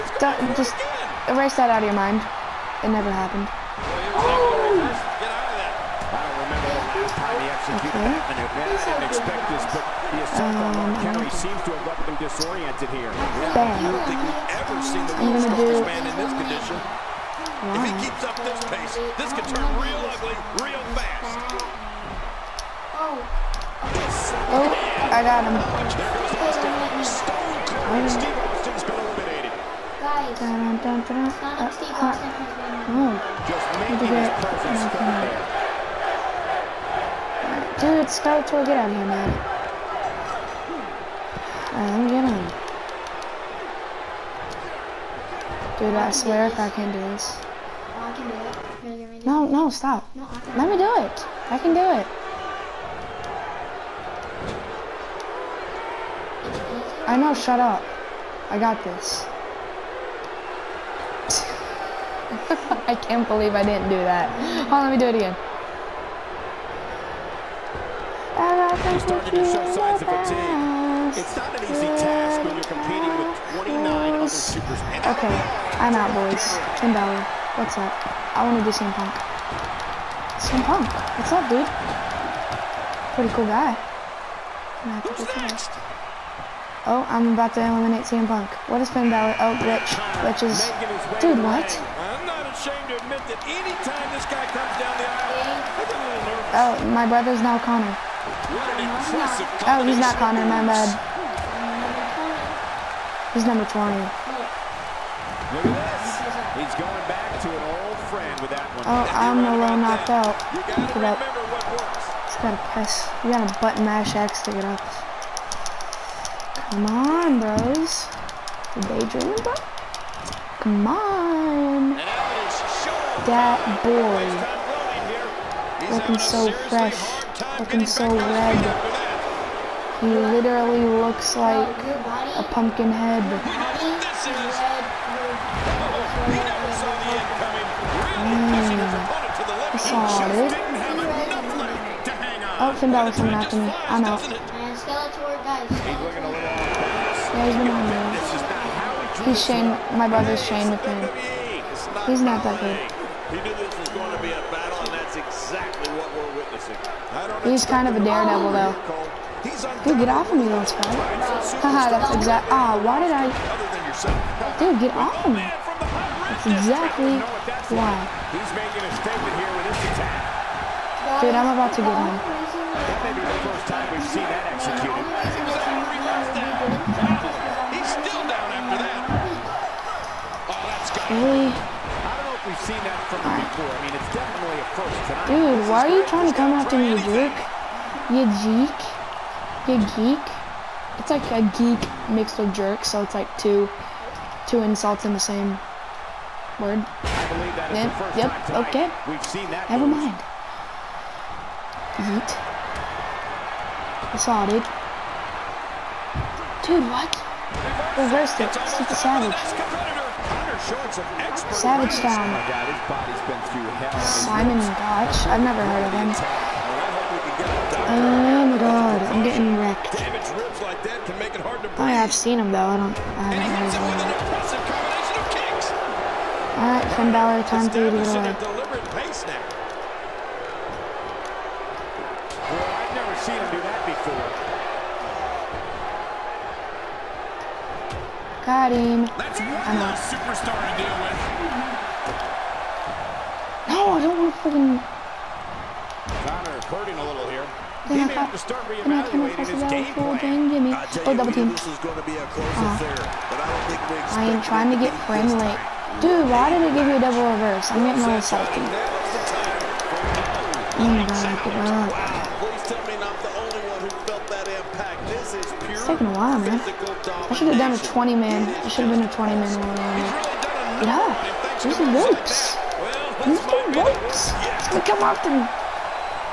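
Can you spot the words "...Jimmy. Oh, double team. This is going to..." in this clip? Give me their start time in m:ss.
4:10.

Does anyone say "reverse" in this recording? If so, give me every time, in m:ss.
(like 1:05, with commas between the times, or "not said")
3:27, 4:17.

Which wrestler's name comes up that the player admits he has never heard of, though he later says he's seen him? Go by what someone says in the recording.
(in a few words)
Simon Gotch.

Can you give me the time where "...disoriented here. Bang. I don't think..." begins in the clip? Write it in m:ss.
0:12.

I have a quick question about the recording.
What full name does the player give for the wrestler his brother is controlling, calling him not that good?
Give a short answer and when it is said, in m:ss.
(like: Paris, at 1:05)
Shane Dupree, at 2:30.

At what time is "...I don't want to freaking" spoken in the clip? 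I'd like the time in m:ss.
4:03.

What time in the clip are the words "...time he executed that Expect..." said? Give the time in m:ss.
0:07.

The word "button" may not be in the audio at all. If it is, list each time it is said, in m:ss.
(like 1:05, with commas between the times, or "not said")
1:53.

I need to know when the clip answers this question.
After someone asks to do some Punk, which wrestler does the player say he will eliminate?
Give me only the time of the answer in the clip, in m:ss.
1:28.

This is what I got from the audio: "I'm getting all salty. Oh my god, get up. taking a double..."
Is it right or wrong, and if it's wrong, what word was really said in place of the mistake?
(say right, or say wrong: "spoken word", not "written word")
wrong: "while", not "double".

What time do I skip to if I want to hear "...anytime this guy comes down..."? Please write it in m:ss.
1:33.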